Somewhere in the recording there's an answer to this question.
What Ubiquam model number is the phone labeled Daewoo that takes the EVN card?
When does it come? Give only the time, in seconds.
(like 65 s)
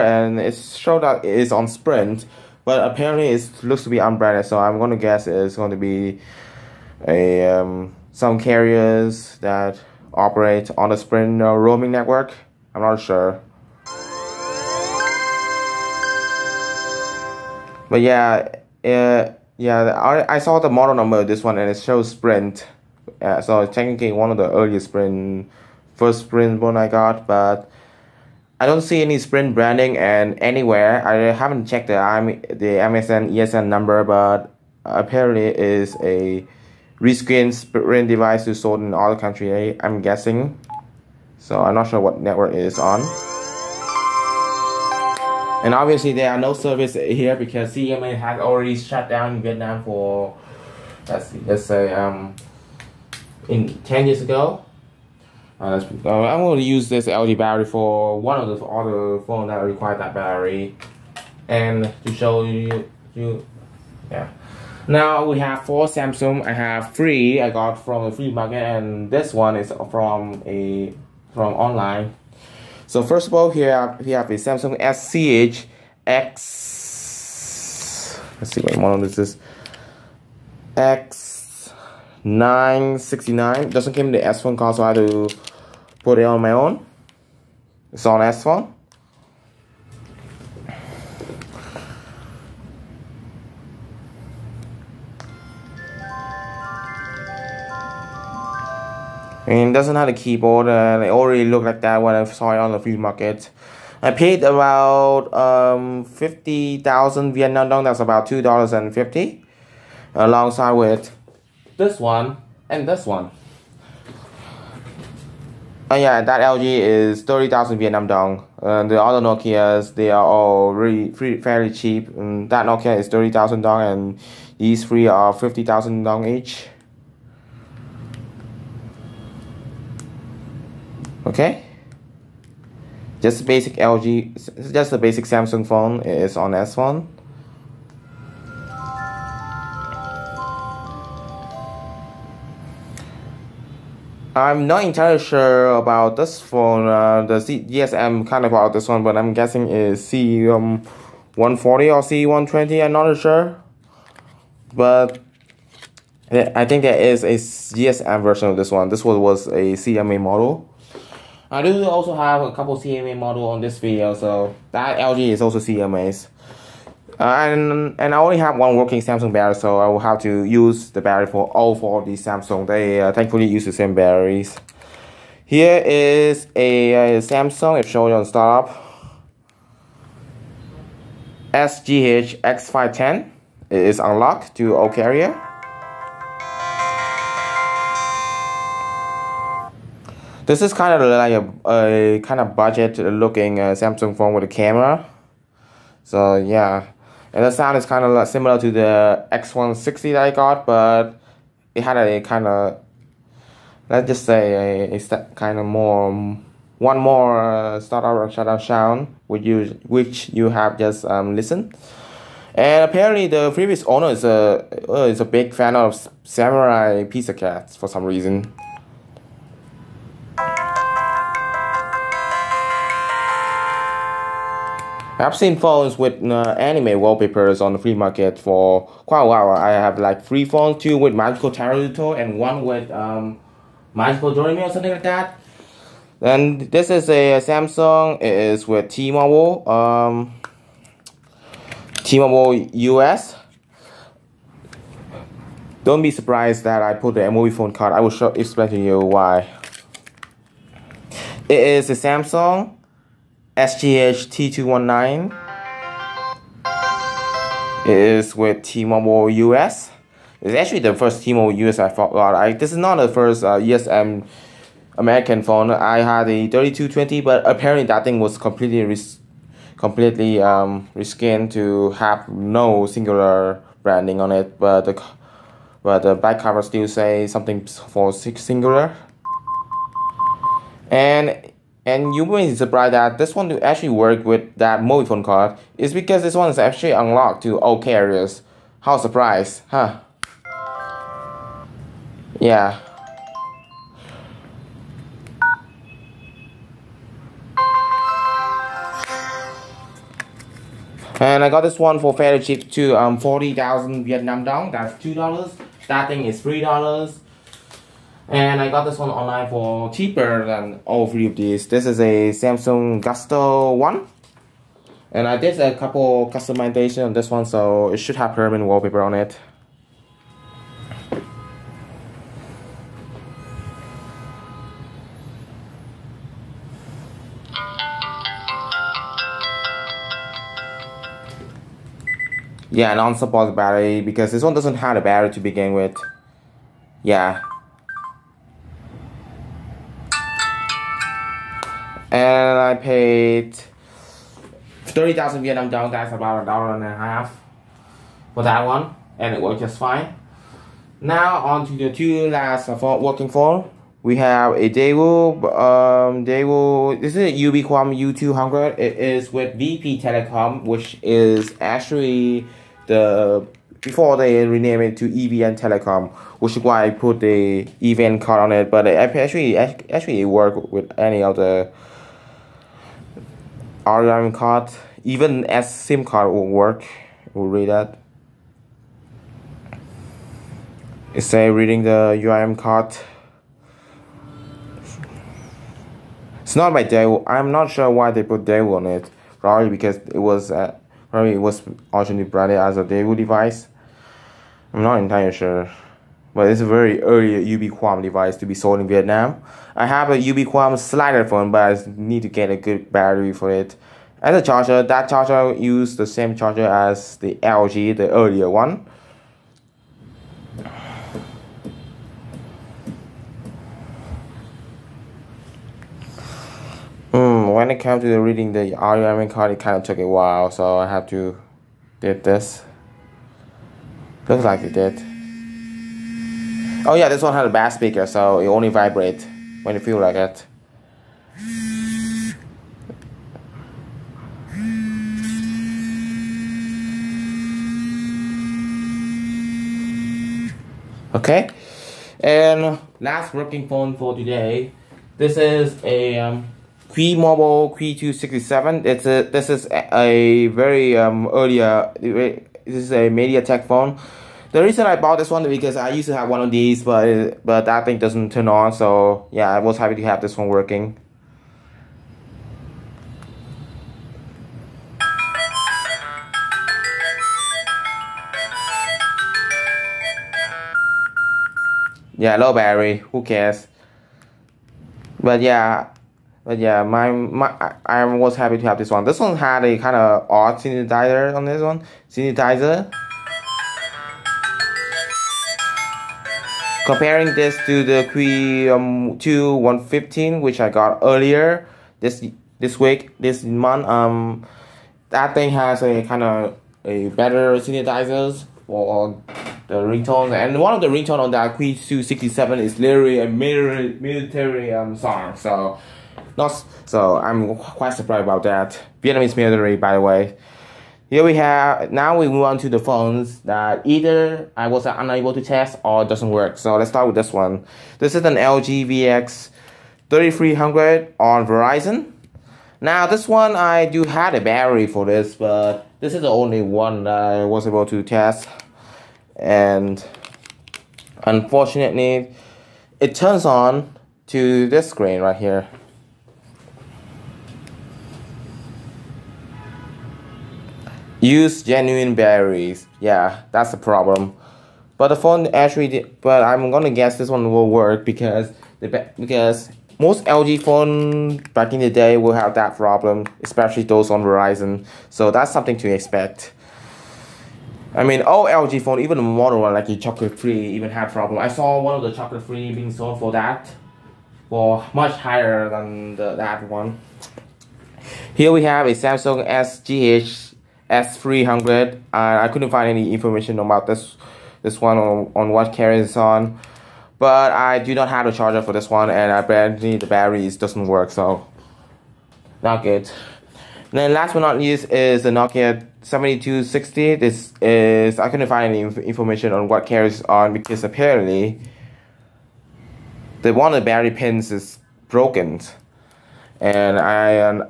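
357 s.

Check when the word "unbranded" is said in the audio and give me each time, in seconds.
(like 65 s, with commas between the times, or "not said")
3 s.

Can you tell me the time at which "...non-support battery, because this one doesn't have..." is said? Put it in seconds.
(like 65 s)
332 s.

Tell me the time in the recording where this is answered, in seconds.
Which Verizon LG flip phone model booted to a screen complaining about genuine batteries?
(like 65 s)
518 s.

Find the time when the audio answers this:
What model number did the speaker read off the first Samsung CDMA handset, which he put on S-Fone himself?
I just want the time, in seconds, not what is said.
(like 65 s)
80 s.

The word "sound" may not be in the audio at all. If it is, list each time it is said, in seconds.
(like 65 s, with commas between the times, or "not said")
197 s, 208 s.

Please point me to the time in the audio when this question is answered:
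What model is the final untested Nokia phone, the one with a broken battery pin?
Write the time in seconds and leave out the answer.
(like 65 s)
585 s.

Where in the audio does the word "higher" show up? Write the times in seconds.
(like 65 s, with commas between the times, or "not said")
565 s.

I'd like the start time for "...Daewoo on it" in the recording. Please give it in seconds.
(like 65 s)
388 s.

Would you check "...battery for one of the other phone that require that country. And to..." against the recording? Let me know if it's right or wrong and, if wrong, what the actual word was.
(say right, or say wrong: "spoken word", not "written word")
wrong: "battery", not "country".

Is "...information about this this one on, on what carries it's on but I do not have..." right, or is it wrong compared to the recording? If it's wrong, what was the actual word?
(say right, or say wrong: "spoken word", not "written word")
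right.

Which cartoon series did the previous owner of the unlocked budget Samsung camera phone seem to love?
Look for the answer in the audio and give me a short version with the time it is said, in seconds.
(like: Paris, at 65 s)
Samurai Pizza Cats, at 216 s.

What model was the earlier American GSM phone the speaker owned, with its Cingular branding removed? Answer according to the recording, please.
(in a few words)
3220.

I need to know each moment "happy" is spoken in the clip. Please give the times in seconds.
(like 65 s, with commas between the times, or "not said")
459 s, 478 s.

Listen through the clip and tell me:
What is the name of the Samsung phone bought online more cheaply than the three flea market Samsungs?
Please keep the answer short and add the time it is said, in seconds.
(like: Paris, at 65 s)
Samsung Gusto 1, at 312 s.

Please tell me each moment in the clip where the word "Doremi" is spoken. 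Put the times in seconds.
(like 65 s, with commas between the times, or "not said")
234 s.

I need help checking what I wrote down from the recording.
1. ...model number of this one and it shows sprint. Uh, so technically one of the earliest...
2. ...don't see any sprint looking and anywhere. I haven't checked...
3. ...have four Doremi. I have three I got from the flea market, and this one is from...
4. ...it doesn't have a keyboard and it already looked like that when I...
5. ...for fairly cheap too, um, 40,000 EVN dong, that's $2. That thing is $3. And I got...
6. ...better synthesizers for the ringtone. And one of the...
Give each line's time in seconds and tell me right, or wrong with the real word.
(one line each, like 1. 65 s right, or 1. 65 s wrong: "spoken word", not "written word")
1. 20 s right
2. 28 s wrong: "branding", not "looking"
3. 65 s wrong: "Samsung", not "Doremi"
4. 99 s right
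5. 301 s wrong: "Vietnam", not "EVN"
6. 497 s right.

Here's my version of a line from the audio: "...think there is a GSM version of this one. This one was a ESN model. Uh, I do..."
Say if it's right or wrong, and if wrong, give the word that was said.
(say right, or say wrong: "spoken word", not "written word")
wrong: "CMA", not "ESN".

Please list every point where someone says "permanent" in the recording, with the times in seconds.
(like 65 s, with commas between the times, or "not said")
318 s.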